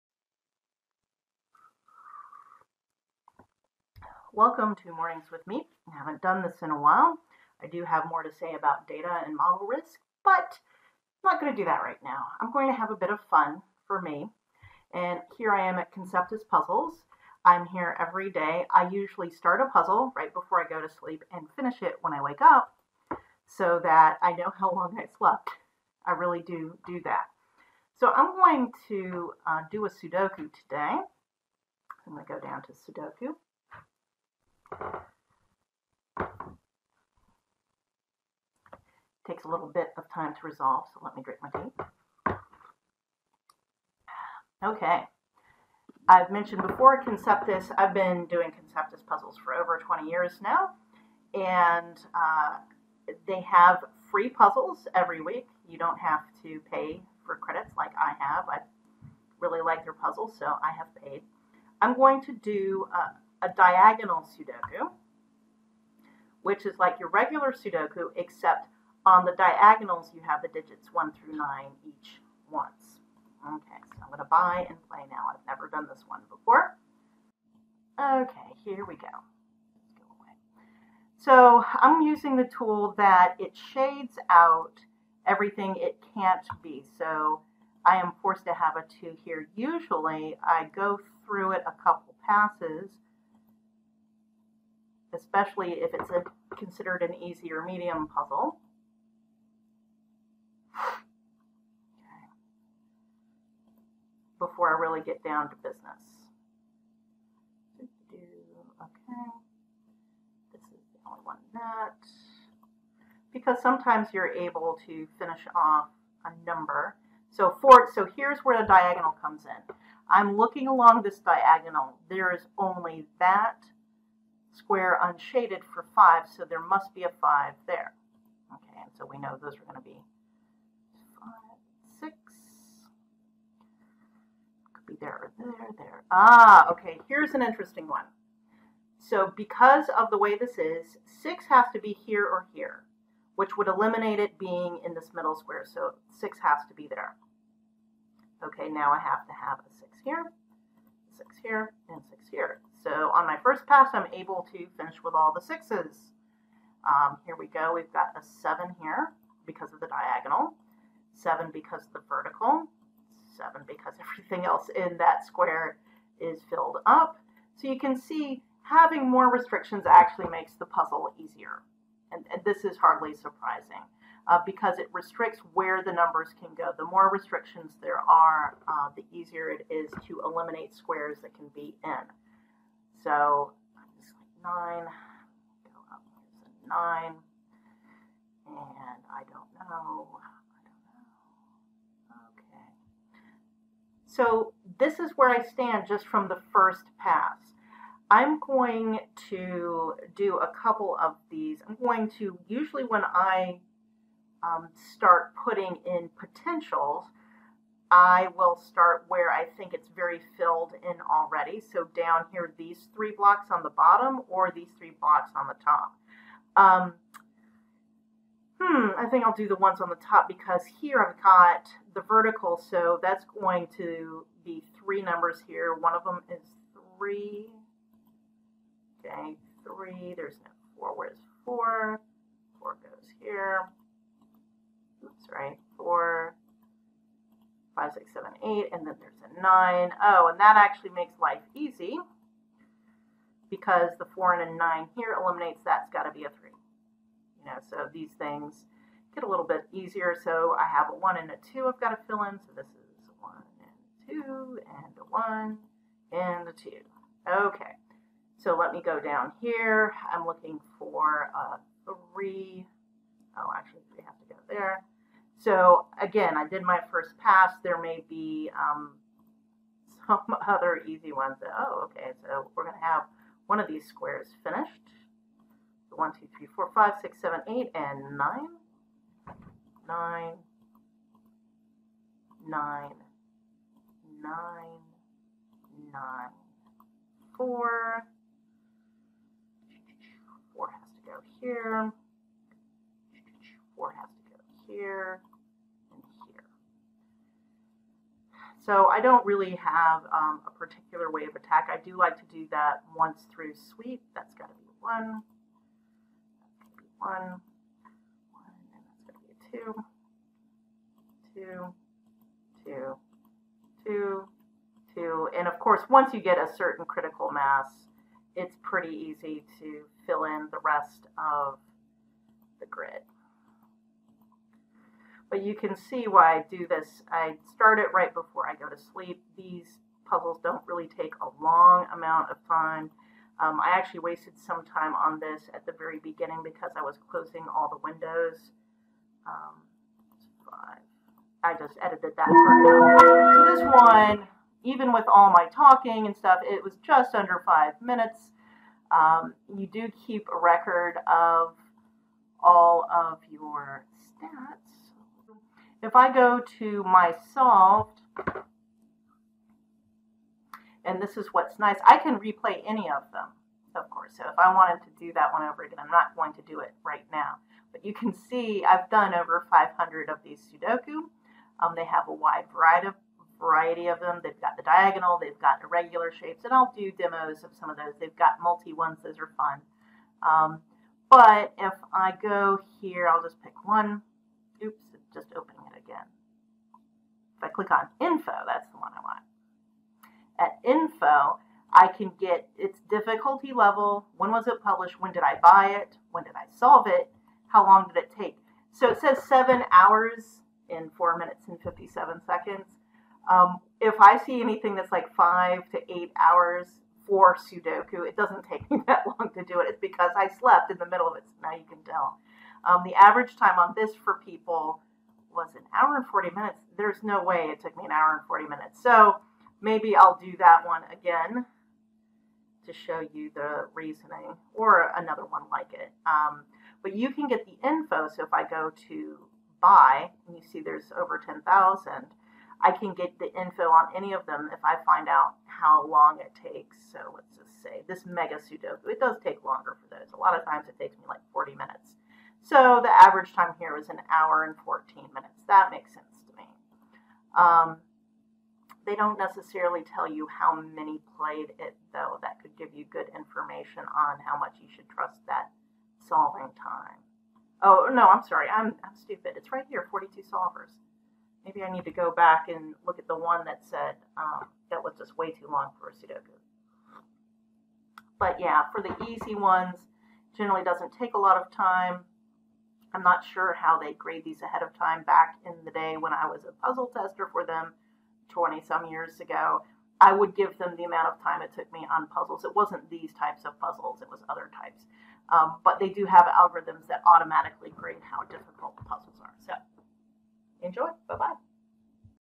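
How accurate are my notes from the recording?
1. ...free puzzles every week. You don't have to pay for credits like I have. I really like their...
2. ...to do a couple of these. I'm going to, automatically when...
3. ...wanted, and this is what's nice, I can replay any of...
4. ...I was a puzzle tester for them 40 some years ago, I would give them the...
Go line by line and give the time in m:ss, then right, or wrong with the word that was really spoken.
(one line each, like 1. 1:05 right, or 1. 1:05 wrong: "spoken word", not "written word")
1. 0:54 right
2. 3:19 wrong: "usually", not "automatically"
3. 5:57 wrong: "solved", not "wanted"
4. 7:56 wrong: "20", not "40".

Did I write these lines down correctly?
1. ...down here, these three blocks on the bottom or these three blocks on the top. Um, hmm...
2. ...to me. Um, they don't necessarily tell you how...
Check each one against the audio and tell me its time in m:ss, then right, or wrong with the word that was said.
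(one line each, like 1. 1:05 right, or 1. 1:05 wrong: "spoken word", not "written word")
1. 3:31 right
2. 7:26 right.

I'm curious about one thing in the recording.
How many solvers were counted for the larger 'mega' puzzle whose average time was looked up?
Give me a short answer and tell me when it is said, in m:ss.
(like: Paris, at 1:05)
42, at 7:39.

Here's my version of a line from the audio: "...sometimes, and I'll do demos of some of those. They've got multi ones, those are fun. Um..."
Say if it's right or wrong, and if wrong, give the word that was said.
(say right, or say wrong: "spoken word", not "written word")
wrong: "shapes", not "sometimes".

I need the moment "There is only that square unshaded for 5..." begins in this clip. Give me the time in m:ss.
2:02.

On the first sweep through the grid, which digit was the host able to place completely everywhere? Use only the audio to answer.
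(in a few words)
6.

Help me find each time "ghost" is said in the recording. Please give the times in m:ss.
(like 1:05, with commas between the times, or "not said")
not said.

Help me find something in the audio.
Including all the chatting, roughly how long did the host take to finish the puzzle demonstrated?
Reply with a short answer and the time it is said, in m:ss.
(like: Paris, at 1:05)
just under five minutes, at 5:46.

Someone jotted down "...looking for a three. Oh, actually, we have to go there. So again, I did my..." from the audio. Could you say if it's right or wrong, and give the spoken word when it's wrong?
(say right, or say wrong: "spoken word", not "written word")
right.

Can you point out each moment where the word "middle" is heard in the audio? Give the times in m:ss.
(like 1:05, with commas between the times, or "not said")
2:25, 6:50.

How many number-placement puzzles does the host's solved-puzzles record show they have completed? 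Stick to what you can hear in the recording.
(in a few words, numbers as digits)
over 500.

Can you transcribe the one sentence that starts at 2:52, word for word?
And, and this is hardly surprising uh, because it restricts where the numbers can go.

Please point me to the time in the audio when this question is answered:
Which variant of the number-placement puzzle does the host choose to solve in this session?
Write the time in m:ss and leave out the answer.
1:03.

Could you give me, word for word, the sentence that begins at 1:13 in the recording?
Okay, so I'm going to buy and play now.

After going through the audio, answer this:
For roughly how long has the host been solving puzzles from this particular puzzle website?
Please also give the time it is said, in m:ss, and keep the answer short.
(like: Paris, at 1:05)
over 20 years, at 0:49.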